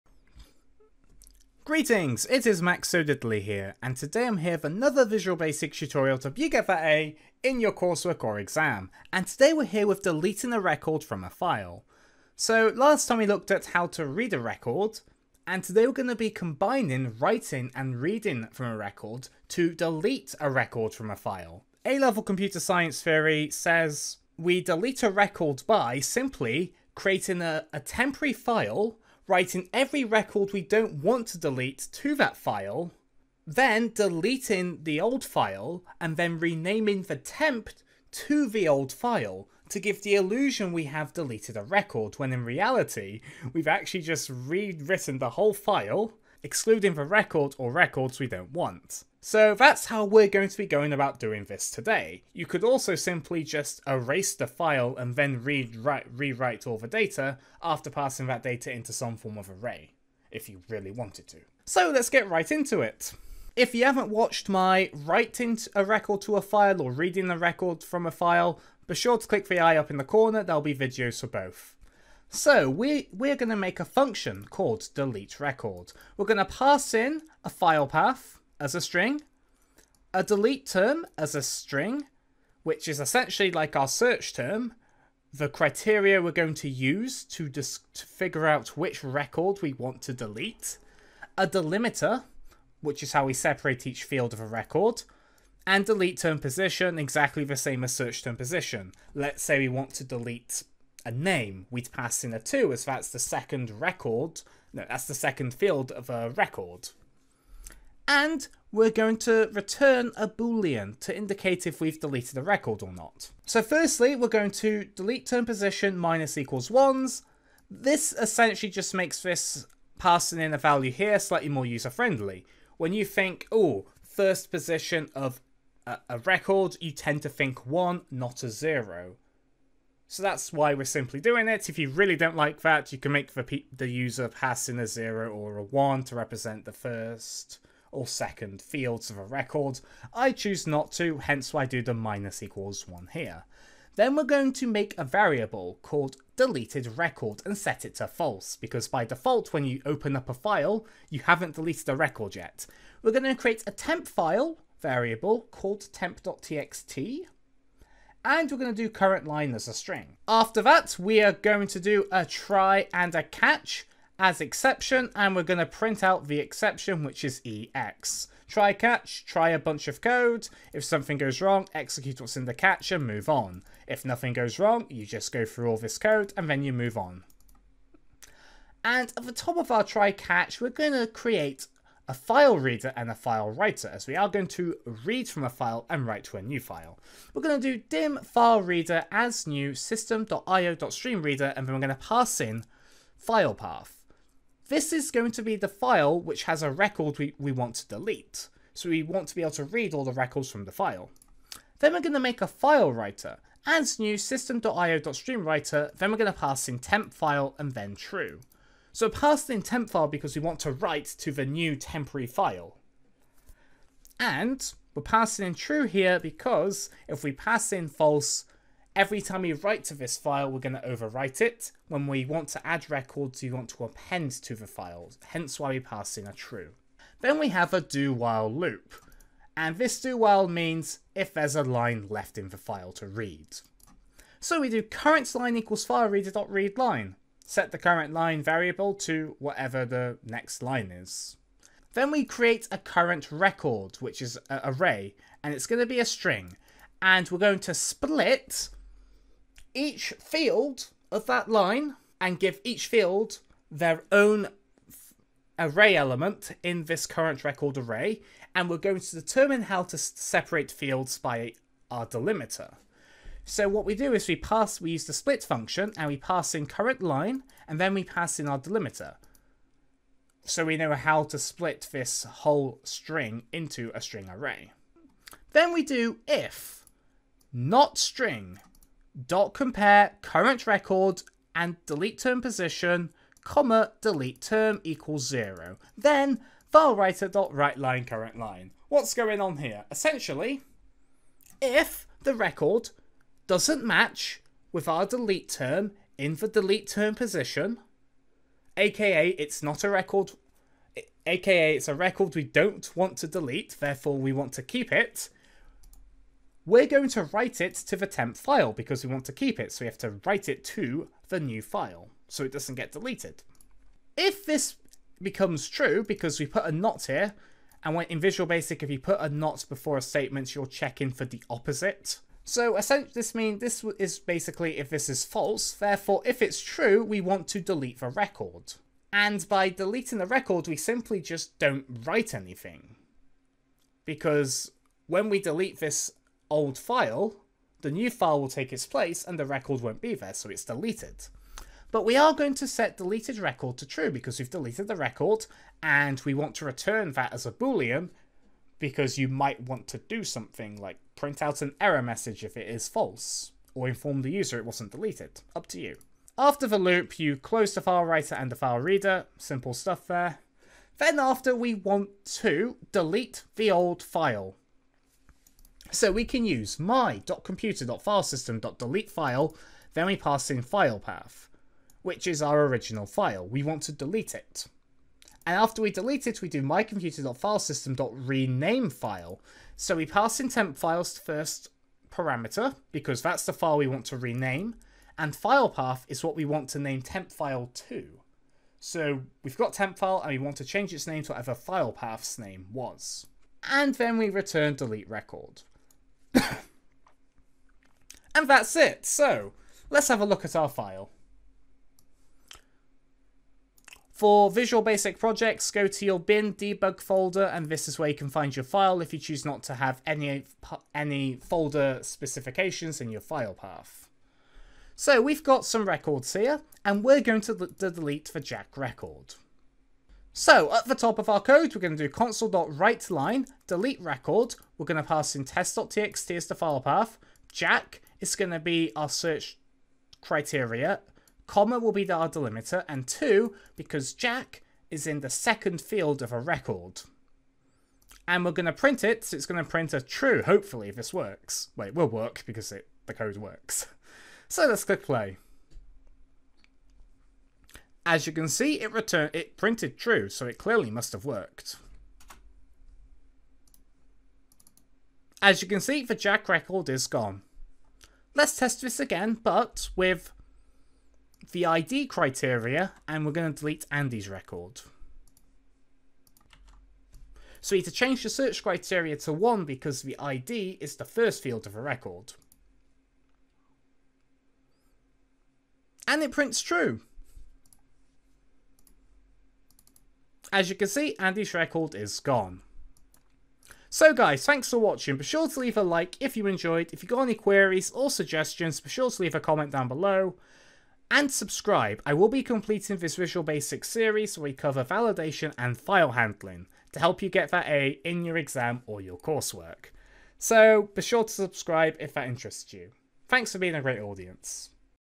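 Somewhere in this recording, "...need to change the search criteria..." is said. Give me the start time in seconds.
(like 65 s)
467 s.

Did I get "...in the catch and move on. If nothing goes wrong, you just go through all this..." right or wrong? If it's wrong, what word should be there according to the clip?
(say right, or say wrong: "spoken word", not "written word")
right.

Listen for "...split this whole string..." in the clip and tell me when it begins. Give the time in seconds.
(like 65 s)
271 s.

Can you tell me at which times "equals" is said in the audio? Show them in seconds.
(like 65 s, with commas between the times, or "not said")
116 s, 142 s, 235 s, 284 s.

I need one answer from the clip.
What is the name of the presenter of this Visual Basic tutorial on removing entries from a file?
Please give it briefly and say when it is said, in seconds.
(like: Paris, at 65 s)
Max So, at 2 s.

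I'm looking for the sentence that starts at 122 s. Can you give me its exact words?
When you think, oh, first position of a, a record, you tend to think one, not a zero.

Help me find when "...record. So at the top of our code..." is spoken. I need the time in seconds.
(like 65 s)
418 s.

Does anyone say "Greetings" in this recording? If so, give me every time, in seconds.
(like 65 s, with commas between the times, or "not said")
1 s.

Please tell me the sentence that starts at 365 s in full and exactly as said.
So we can use my.computer.filesystem.deletefile, file, then we pass in file path, which is our original file.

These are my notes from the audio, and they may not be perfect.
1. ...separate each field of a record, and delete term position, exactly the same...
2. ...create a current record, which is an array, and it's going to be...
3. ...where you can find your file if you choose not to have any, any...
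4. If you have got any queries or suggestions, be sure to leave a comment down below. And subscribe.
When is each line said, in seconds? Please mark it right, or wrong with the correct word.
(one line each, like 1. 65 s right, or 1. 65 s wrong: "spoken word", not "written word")
1. 93 s right
2. 242 s right
3. 407 s right
4. 486 s right.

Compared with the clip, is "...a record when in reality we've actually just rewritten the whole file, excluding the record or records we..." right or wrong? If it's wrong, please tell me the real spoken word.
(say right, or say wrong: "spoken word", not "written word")
right.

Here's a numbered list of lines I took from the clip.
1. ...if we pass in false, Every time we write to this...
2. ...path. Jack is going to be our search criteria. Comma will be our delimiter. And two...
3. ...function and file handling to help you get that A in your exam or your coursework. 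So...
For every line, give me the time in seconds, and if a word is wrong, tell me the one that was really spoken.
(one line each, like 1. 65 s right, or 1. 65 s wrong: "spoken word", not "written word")
1. 217 s right
2. 426 s right
3. 494 s wrong: "validation", not "function".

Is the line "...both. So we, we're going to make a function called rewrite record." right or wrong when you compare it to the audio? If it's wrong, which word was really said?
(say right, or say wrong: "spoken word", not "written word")
wrong: "delete", not "rewrite".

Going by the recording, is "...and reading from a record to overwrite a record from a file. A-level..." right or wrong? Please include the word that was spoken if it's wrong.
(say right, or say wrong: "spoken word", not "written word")
wrong: "delete", not "overwrite".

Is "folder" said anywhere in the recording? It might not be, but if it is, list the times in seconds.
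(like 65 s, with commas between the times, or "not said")
407 s, 411 s.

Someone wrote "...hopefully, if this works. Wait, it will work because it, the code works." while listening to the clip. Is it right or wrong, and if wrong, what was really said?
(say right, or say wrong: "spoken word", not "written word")
right.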